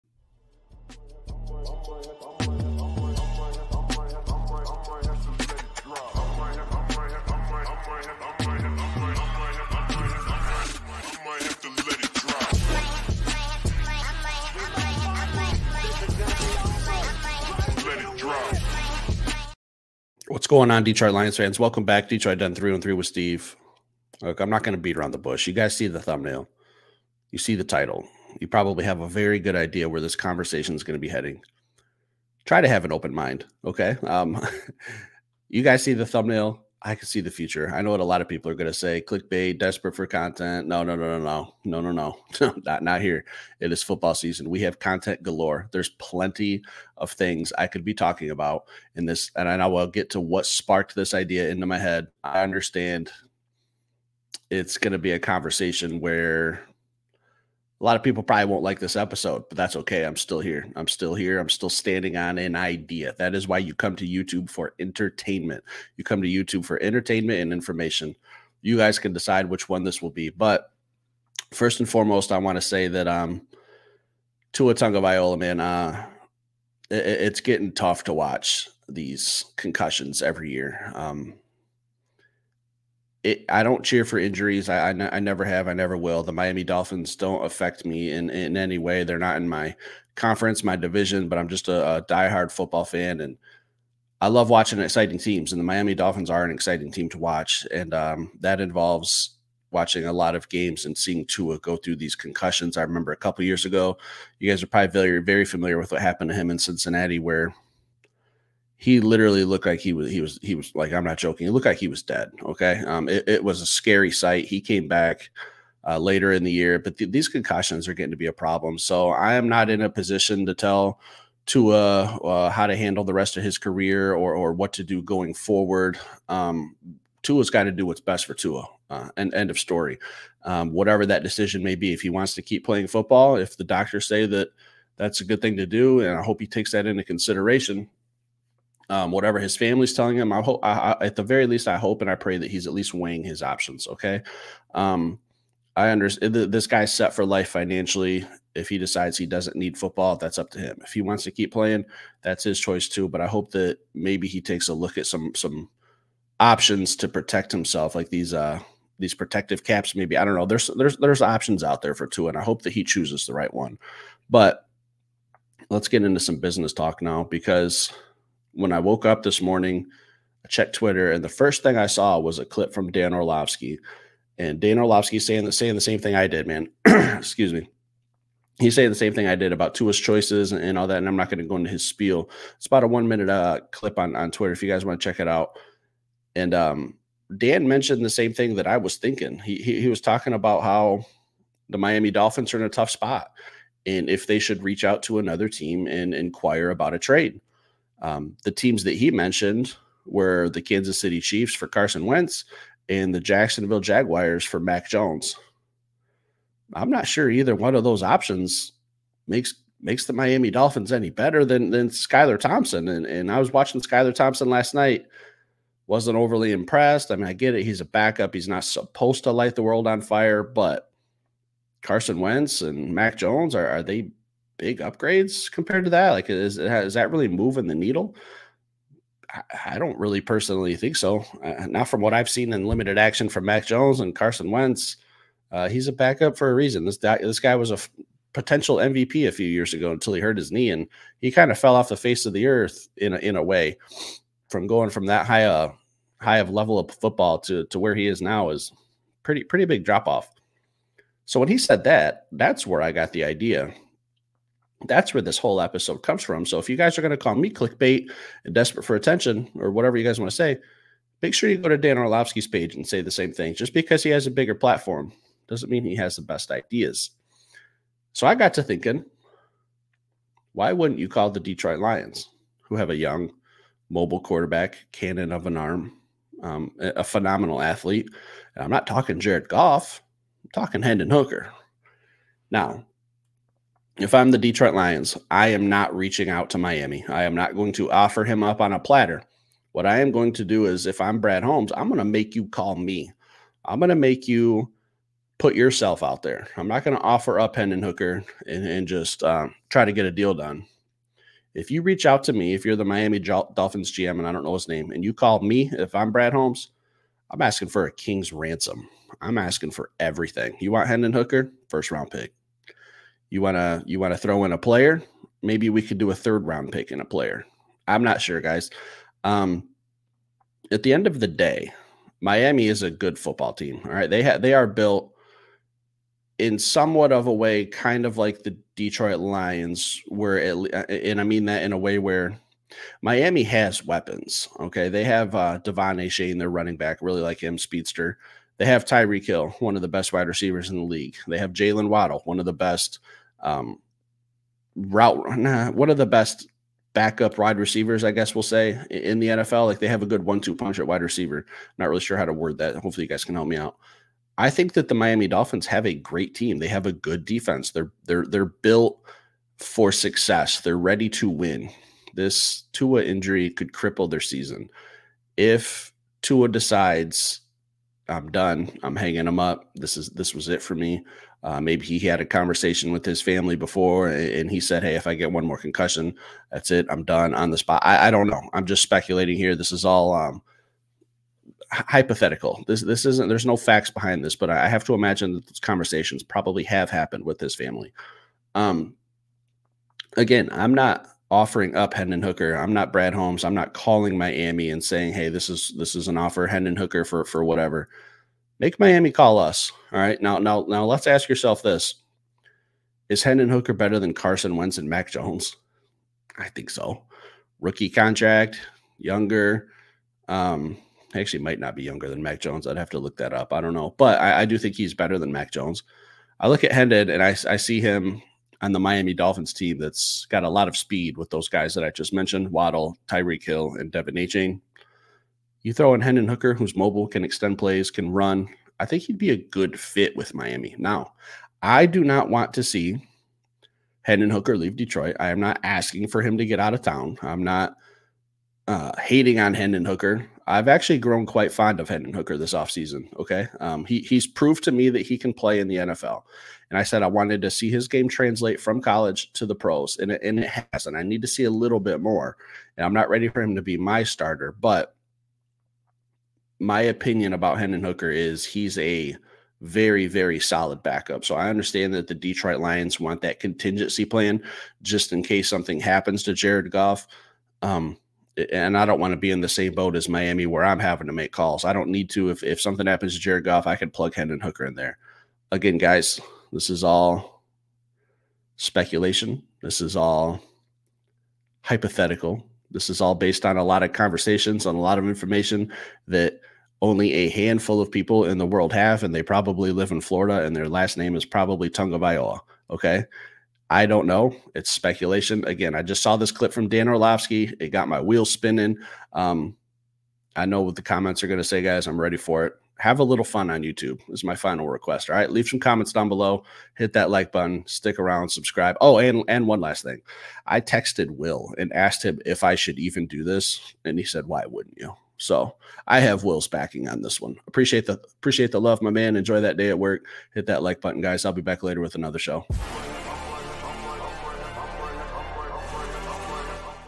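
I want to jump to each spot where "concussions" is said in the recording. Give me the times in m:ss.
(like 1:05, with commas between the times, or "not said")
1:19, 1:42, 1:57, 6:15.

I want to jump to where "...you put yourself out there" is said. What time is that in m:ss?
4:54.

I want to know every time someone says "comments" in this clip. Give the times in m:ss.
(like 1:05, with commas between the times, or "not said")
8:20, 8:25.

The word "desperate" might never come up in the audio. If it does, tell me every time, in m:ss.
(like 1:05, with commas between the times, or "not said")
0:39, 4:18.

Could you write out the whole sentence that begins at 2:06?
Um, Tua's got to do what's best for Tua.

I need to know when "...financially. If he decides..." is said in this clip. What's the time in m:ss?
2:27.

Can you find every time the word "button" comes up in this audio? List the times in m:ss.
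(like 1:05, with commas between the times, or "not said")
8:27, 8:40.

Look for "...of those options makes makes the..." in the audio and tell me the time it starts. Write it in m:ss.
3:27.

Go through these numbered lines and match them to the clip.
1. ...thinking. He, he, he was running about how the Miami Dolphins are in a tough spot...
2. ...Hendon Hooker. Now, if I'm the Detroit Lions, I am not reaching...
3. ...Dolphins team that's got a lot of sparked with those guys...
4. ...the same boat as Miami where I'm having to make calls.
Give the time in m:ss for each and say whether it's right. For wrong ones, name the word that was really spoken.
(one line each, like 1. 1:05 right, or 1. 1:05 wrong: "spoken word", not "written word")
1. 3:08 wrong: "talking", not "running"
2. 4:40 right
3. 6:59 wrong: "speed", not "sparked"
4. 7:49 right.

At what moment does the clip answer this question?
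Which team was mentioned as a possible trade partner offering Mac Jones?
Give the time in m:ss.
3:23.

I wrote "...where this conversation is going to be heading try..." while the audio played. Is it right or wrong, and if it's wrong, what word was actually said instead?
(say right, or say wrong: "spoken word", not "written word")
right.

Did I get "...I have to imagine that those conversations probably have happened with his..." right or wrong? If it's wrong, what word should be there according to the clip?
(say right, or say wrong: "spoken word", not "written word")
right.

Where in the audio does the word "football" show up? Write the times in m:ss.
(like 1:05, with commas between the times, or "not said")
0:43, 1:32, 2:12, 2:29, 4:06, 5:23.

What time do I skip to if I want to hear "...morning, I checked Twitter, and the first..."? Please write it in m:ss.
2:49.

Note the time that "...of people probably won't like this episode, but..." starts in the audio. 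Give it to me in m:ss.
0:57.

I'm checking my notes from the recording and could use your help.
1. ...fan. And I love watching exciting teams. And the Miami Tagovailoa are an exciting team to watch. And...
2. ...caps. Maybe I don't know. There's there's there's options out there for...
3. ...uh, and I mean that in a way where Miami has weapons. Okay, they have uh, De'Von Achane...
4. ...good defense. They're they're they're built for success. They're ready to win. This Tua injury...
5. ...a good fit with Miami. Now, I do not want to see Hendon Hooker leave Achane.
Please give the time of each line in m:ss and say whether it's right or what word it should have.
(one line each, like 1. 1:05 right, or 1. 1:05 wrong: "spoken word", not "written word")
1. 1:32 wrong: "Dolphins", not "Tagovailoa"
2. 2:39 right
3. 5:30 right
4. 5:56 right
5. 7:09 wrong: "Detroit", not "Achane".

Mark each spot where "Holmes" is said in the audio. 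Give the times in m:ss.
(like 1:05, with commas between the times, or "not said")
4:51, 5:06, 6:33.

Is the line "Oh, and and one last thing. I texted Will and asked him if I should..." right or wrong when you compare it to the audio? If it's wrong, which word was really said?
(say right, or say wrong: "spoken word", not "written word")
right.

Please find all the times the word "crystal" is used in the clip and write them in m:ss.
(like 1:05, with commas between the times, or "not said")
not said.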